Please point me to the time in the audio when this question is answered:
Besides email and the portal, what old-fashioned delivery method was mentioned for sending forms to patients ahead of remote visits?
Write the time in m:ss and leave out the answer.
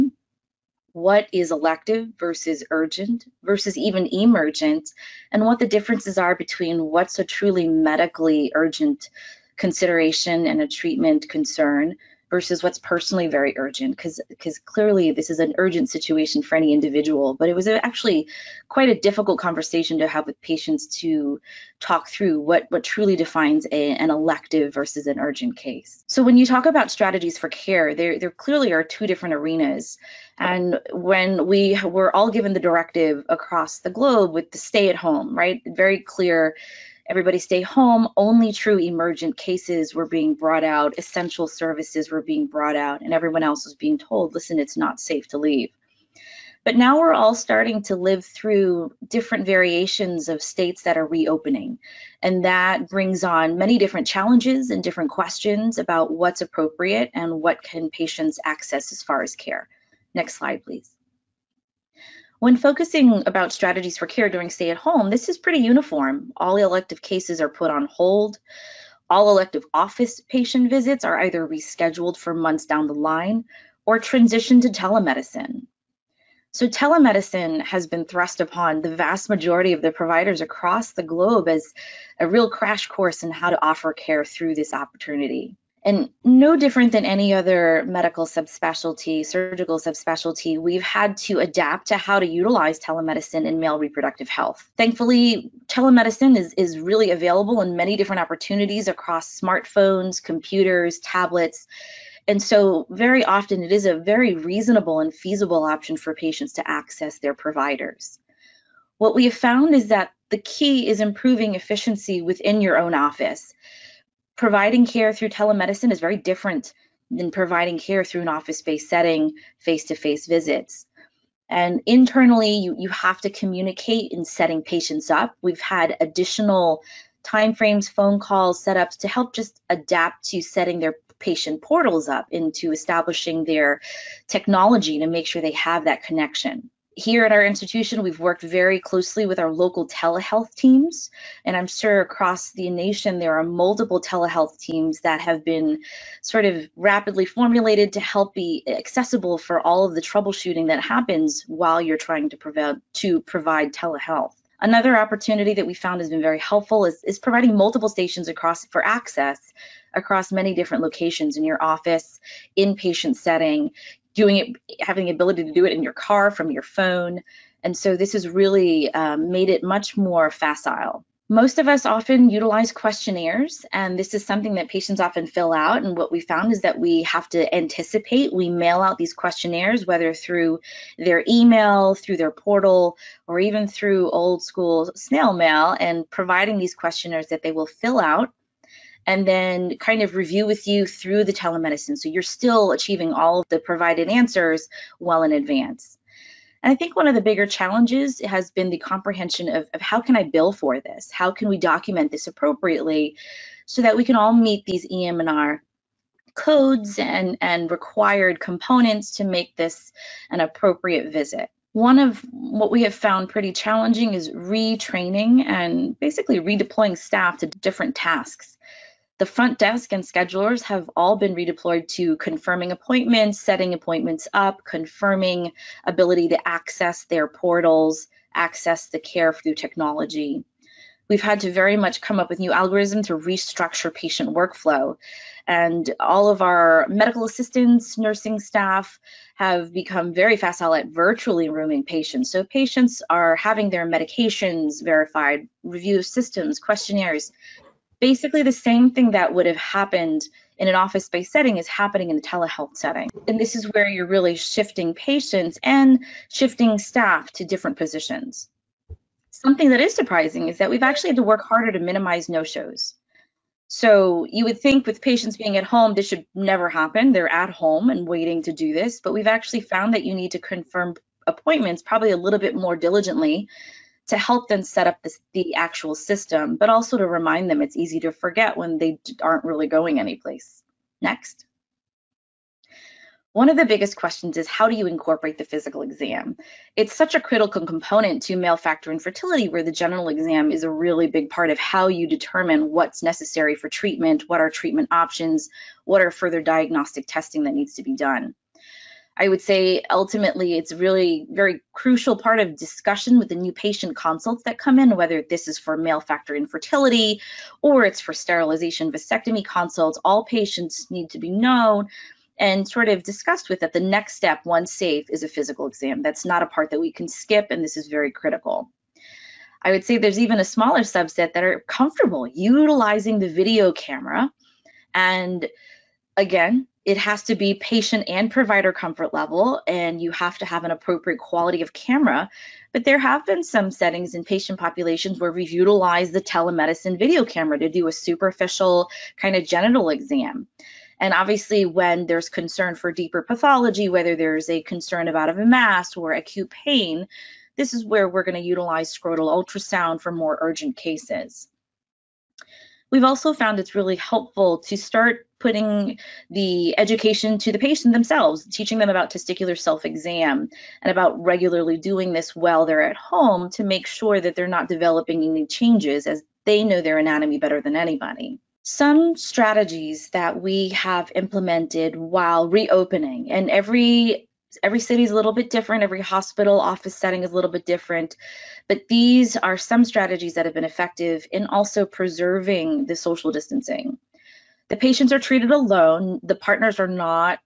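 3:04.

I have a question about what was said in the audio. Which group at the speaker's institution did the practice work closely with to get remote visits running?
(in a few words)
local telehealth teams.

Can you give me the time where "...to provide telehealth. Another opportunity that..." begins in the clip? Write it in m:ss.
2:32.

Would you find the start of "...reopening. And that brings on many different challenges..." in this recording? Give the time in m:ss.
0:51.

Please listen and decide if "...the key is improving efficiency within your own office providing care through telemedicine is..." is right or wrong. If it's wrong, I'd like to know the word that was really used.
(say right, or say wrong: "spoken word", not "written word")
right.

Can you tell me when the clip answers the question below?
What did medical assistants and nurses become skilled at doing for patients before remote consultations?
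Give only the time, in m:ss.
4:00.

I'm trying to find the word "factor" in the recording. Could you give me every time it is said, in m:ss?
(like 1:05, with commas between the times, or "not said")
4:48, 5:06.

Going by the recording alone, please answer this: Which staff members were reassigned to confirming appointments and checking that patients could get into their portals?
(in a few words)
front desk and schedulers.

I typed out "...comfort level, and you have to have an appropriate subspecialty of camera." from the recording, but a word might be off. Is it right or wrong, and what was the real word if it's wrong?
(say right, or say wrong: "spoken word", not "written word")
wrong: "quality", not "subspecialty".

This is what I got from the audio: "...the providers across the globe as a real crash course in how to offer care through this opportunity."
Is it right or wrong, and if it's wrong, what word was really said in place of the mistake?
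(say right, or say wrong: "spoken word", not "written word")
right.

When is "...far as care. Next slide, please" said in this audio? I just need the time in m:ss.
0:59.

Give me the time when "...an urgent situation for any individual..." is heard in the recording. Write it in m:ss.
0:15.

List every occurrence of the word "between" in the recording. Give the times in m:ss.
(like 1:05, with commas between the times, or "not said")
0:06.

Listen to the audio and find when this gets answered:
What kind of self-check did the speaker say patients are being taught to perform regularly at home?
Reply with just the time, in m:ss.
5:59.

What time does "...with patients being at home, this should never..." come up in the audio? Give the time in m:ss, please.
4:24.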